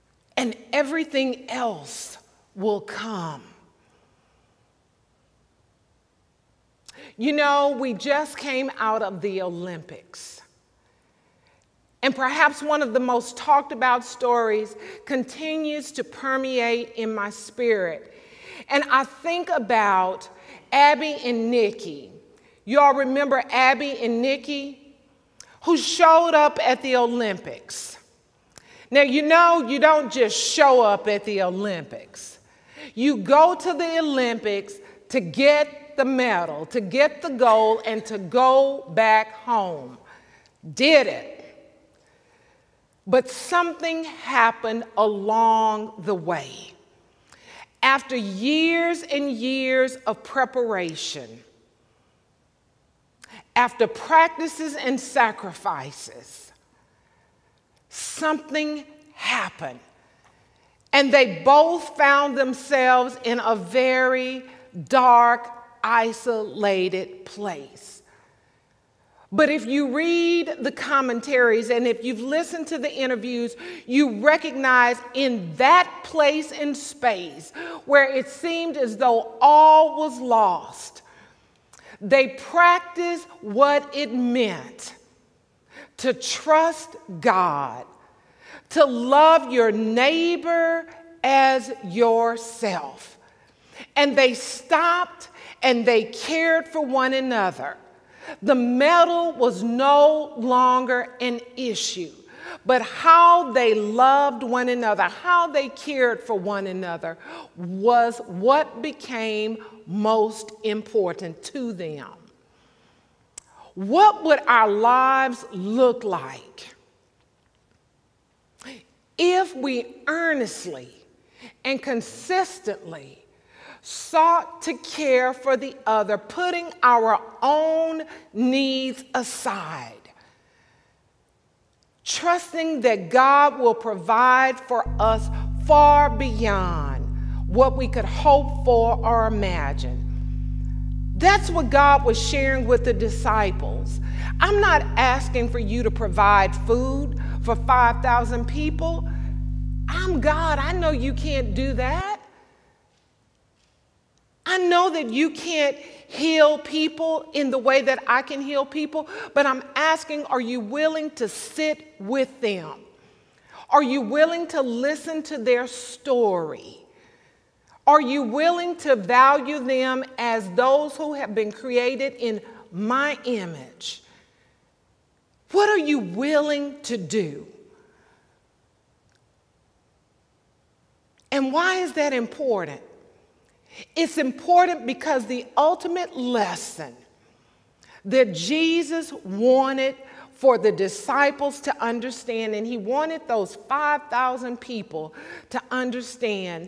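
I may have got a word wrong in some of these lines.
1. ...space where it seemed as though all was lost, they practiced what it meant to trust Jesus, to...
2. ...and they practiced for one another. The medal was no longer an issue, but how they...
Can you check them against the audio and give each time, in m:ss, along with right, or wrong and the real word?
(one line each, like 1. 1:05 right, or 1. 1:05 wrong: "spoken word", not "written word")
1. 1:16 wrong: "God", not "Jesus"
2. 1:35 wrong: "cared", not "practiced".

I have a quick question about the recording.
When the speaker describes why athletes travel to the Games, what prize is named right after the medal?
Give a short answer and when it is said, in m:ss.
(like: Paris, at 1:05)
gold, at 0:37.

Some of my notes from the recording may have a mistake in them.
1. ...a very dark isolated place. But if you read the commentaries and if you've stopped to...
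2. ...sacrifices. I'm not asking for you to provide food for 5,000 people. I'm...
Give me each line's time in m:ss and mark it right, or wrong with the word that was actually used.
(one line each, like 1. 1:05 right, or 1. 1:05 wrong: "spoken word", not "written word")
1. 1:03 wrong: "listened", not "stopped"
2. 2:22 wrong: "disciples", not "sacrifices".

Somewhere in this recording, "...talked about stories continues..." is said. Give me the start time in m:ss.
0:13.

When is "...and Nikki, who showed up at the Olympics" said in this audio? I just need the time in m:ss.
0:23.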